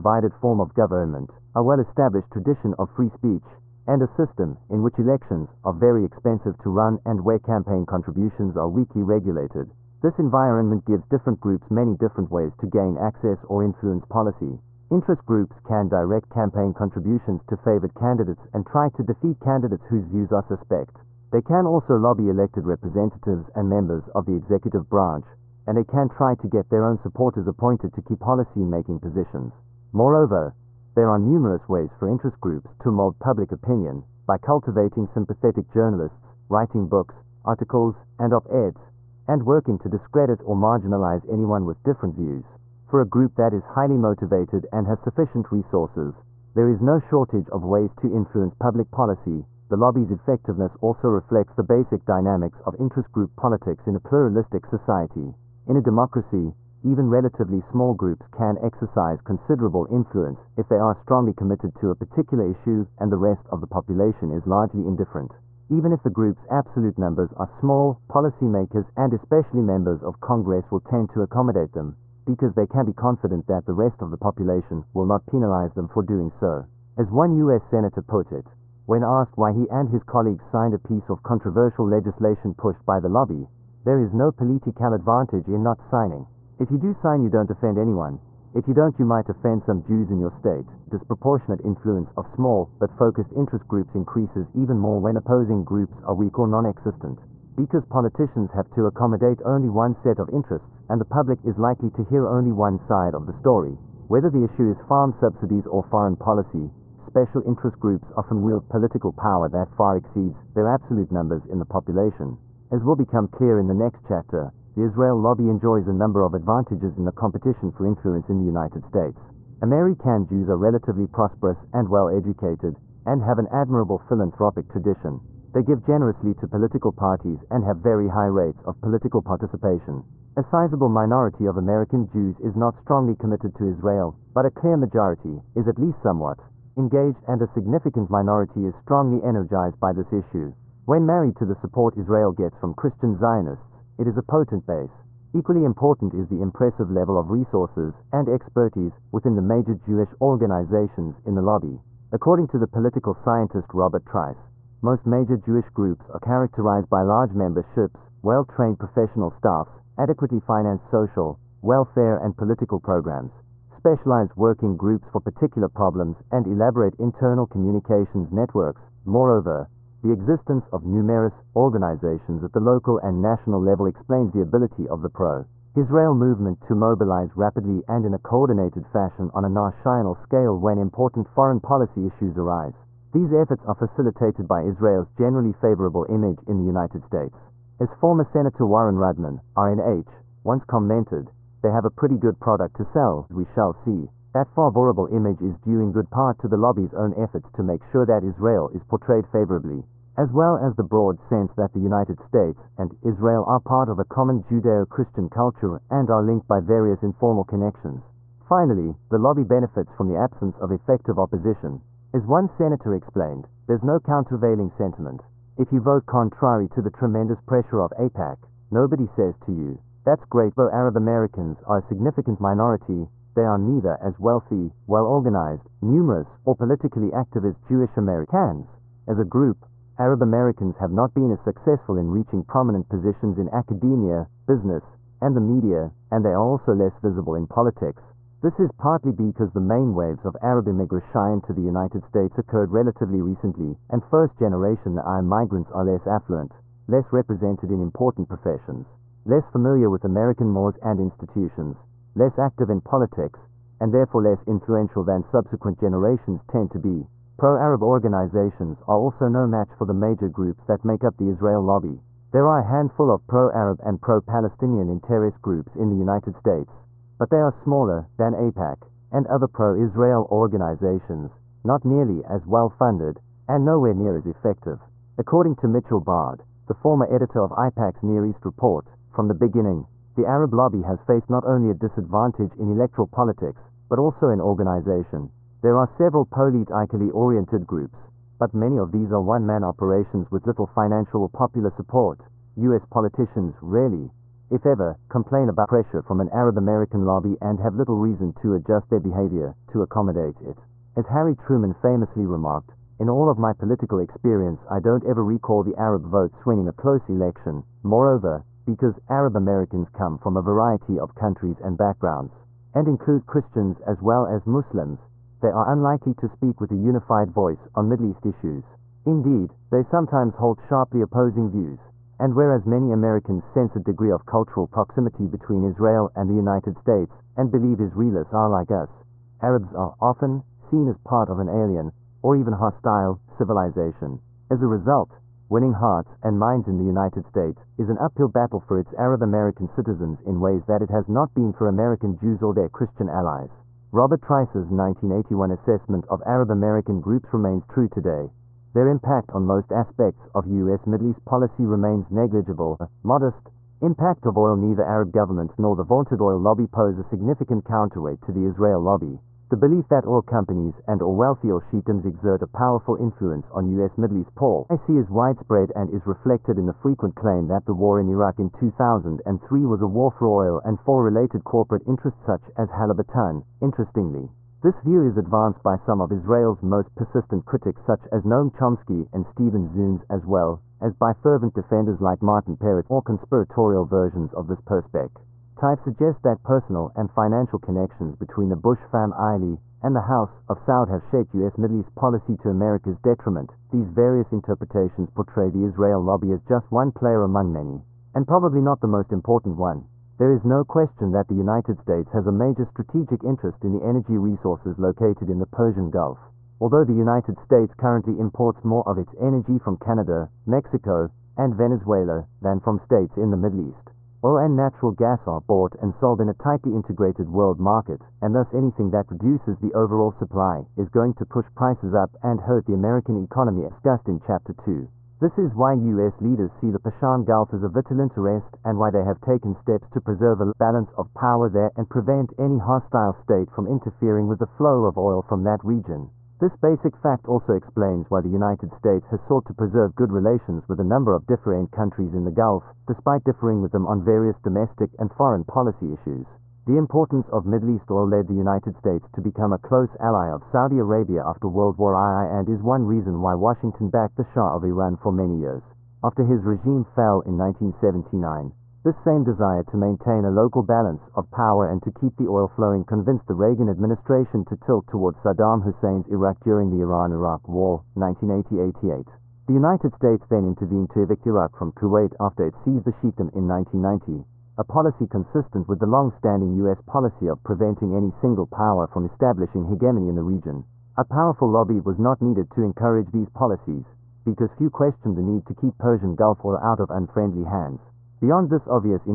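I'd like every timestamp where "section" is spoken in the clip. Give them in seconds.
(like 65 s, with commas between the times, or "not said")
not said.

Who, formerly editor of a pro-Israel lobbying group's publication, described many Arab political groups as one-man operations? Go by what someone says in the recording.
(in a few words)
Mitchell Bard.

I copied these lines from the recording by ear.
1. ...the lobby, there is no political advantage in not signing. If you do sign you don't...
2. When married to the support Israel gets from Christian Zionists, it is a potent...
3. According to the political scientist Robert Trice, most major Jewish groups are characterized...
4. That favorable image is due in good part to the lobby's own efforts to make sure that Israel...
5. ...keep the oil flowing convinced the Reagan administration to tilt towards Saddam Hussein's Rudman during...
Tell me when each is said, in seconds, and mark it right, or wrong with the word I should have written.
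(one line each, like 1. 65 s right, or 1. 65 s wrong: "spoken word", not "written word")
1. 82 s right
2. 140 s right
3. 152 s right
4. 194 s right
5. 461 s wrong: "Iraq", not "Rudman".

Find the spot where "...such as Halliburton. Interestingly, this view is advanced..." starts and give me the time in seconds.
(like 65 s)
372 s.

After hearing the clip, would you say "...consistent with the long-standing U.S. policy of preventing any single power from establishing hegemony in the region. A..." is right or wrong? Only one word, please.
right.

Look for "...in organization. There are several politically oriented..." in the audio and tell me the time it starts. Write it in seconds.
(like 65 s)
284 s.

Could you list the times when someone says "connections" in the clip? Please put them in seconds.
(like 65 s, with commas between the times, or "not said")
207 s, 387 s.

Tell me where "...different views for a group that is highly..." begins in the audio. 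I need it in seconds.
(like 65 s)
41 s.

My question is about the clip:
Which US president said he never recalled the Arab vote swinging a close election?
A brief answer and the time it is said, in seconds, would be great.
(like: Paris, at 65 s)
Harry Truman, at 301 s.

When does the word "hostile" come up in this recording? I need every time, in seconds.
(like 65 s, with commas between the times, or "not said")
332 s, 432 s.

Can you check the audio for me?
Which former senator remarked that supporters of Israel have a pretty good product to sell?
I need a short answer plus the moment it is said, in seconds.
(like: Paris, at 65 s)
Warren Rudman, at 188 s.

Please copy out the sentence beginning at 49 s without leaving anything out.
The lobby's effectiveness also reflects the basic dynamics of interest group politics in a pluralistic society.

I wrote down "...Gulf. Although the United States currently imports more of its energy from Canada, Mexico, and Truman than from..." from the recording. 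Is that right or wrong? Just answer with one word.
wrong.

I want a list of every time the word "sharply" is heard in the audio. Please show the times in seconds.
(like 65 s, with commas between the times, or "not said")
320 s.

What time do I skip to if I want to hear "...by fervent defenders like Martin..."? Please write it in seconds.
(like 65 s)
380 s.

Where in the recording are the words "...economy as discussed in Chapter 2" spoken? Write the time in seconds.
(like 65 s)
423 s.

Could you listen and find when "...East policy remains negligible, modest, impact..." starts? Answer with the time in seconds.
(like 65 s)
351 s.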